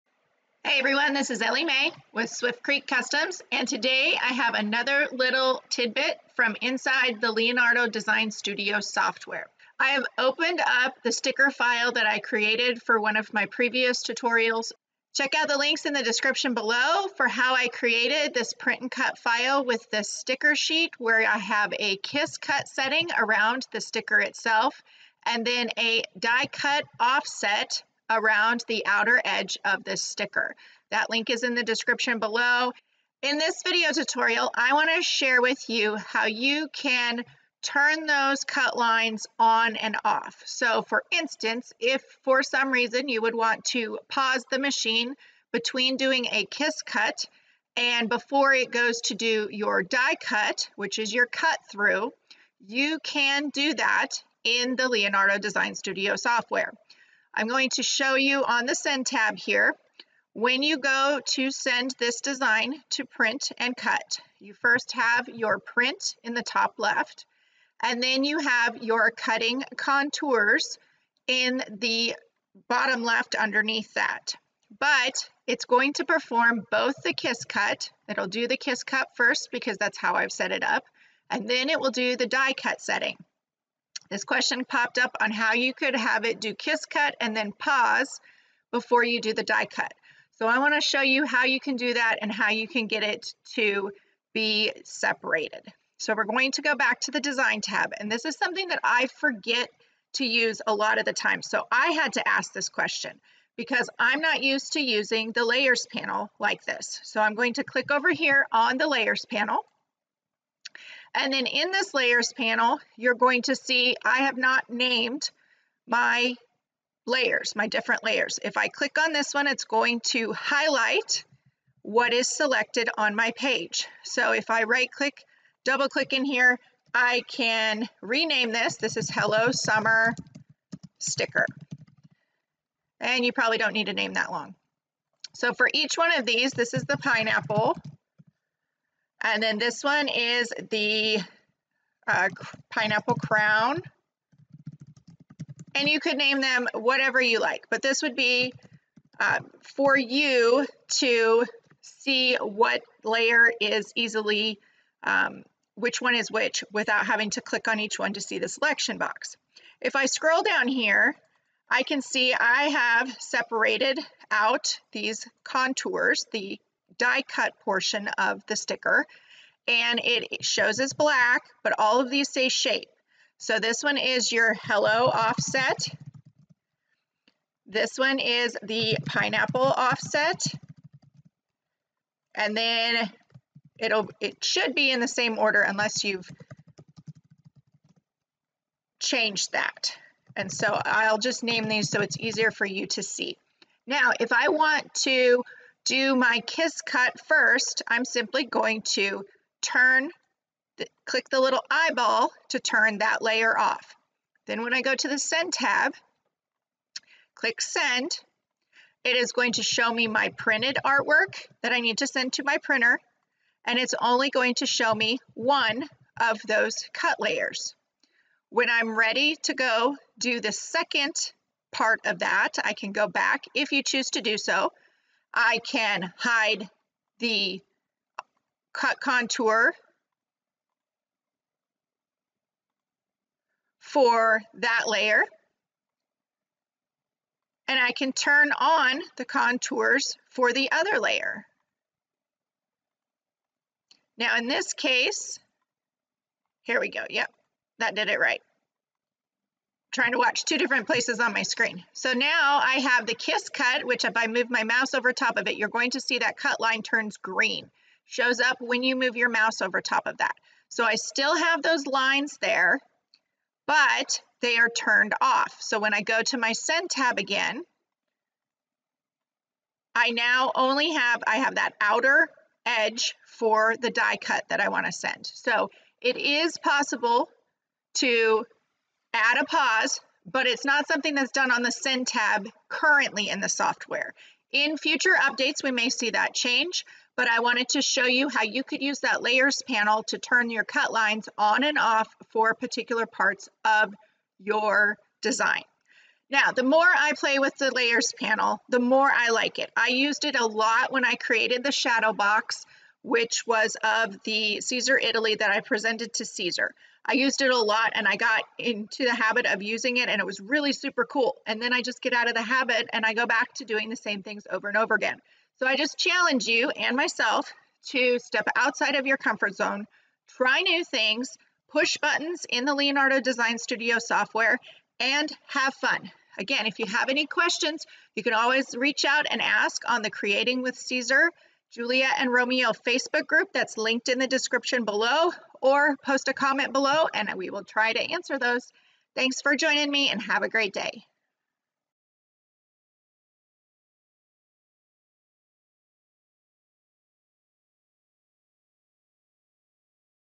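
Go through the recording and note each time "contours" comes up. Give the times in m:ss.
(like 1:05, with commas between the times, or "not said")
1:09, 2:45, 3:48, 3:59.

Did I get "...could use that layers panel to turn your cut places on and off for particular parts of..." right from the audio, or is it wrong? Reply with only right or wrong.
wrong.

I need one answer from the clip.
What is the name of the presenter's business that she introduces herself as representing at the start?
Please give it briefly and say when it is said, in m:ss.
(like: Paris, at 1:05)
Swift Creek Customs, at 0:02.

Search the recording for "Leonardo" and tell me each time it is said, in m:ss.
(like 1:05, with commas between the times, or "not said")
0:07, 0:54, 5:22.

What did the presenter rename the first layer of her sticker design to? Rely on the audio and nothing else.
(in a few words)
Hello Summer sticker.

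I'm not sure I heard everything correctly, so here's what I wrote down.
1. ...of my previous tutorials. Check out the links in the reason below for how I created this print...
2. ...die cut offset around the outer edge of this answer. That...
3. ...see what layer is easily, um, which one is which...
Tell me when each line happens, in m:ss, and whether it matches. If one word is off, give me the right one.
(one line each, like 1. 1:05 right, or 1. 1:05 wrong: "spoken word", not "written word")
1. 0:13 wrong: "description", not "reason"
2. 0:26 wrong: "sticker", not "answer"
3. 2:31 right.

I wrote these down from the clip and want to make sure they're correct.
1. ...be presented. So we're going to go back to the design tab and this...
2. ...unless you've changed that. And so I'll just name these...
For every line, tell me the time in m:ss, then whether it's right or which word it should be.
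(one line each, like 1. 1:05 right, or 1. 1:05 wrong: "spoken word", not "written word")
1. 1:34 wrong: "separated", not "presented"
2. 3:05 right.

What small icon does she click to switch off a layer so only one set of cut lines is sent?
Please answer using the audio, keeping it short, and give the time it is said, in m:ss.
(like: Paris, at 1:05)
Eyeball, at 3:21.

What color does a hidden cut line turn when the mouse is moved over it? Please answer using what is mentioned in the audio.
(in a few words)
Green.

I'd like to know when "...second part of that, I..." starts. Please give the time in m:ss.
3:40.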